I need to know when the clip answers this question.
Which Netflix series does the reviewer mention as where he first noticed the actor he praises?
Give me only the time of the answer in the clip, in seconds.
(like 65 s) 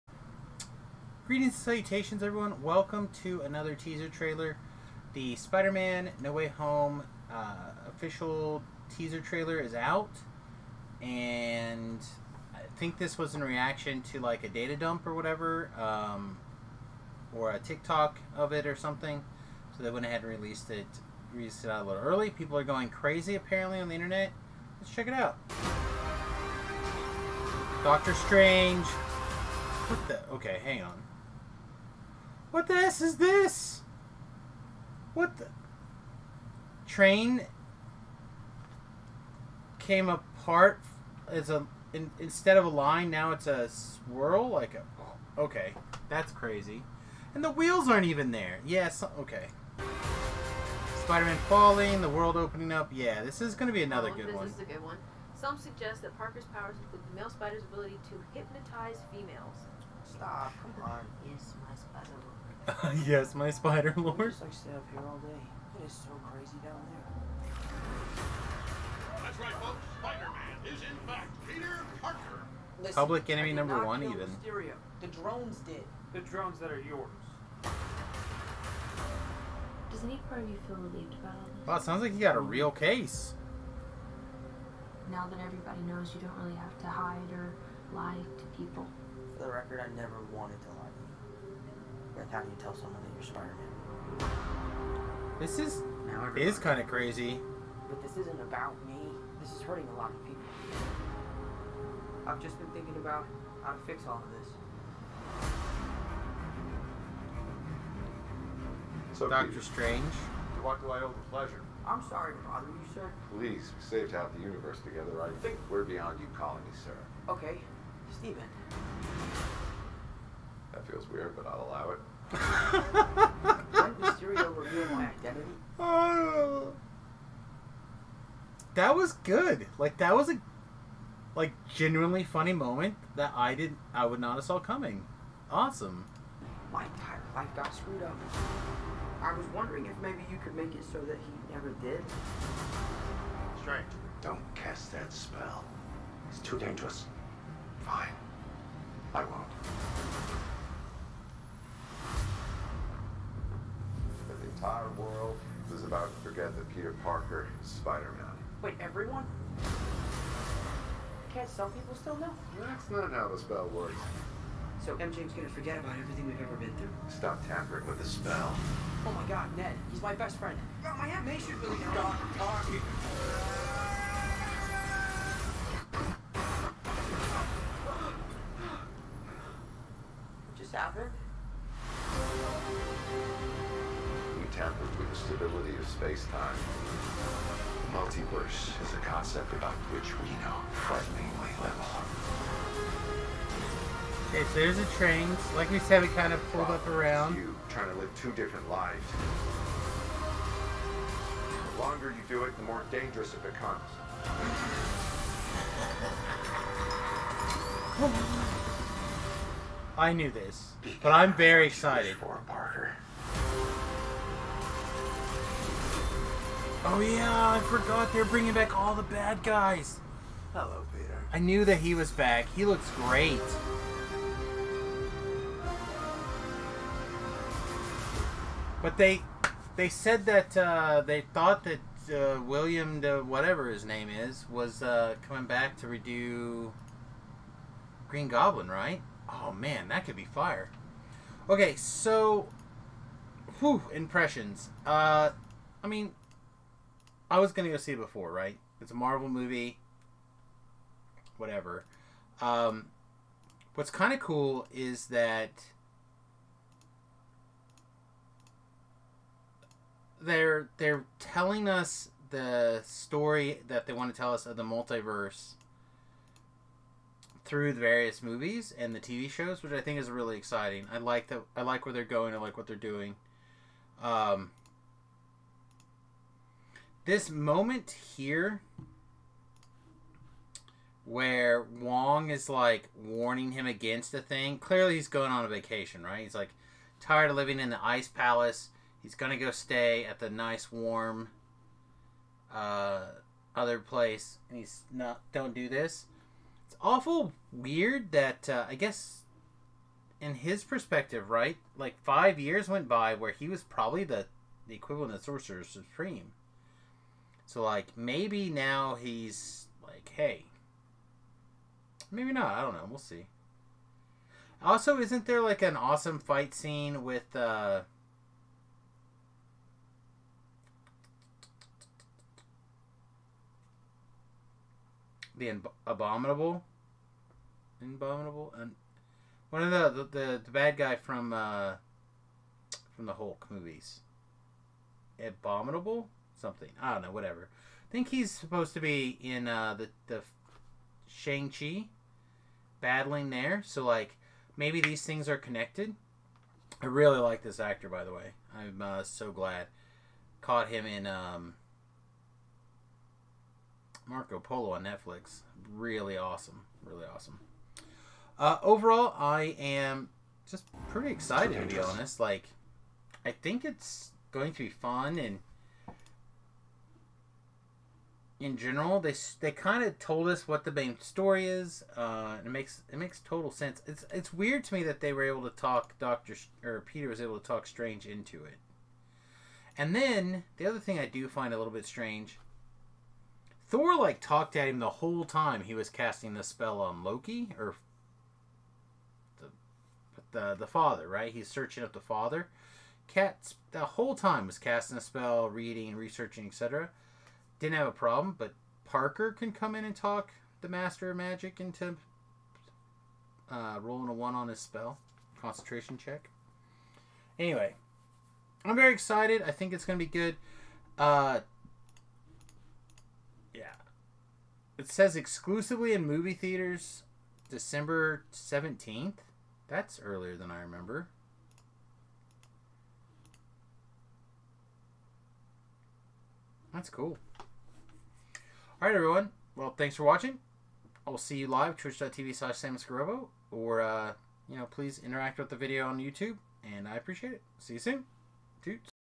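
354 s.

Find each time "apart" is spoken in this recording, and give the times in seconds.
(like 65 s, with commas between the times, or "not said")
40 s.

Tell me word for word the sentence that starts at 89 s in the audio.
For the record, I never wanted to lie to you.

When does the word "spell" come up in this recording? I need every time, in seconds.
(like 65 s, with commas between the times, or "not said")
145 s, 163 s, 168 s, 386 s, 395 s, 404 s.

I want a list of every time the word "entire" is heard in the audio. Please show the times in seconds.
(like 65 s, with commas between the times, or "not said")
136 s, 154 s.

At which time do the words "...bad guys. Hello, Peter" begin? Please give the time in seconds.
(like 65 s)
219 s.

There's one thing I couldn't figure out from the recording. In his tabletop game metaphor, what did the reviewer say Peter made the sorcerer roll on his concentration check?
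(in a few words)
a one.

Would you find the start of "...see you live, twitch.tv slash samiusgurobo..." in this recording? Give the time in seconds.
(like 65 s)
431 s.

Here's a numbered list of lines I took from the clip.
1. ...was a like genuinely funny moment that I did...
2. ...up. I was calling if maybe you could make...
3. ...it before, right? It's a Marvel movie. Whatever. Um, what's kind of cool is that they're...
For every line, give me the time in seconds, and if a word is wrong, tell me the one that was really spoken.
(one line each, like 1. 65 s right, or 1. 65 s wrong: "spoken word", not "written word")
1. 130 s right
2. 138 s wrong: "wondering", not "calling"
3. 247 s right.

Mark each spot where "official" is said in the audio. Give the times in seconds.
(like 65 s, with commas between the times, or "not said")
7 s.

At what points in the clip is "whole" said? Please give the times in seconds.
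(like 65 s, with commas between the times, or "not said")
384 s, 393 s.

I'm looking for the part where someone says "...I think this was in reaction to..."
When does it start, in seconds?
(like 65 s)
12 s.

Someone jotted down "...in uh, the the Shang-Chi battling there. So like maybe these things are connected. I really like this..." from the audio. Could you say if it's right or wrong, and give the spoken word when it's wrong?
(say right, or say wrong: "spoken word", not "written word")
right.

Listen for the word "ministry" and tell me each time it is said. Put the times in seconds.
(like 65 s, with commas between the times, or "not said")
not said.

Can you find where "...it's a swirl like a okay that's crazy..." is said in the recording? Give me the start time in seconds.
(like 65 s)
43 s.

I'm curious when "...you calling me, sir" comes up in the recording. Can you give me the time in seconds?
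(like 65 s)
116 s.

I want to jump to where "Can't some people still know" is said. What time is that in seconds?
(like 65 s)
161 s.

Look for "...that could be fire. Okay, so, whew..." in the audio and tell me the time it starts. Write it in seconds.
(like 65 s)
239 s.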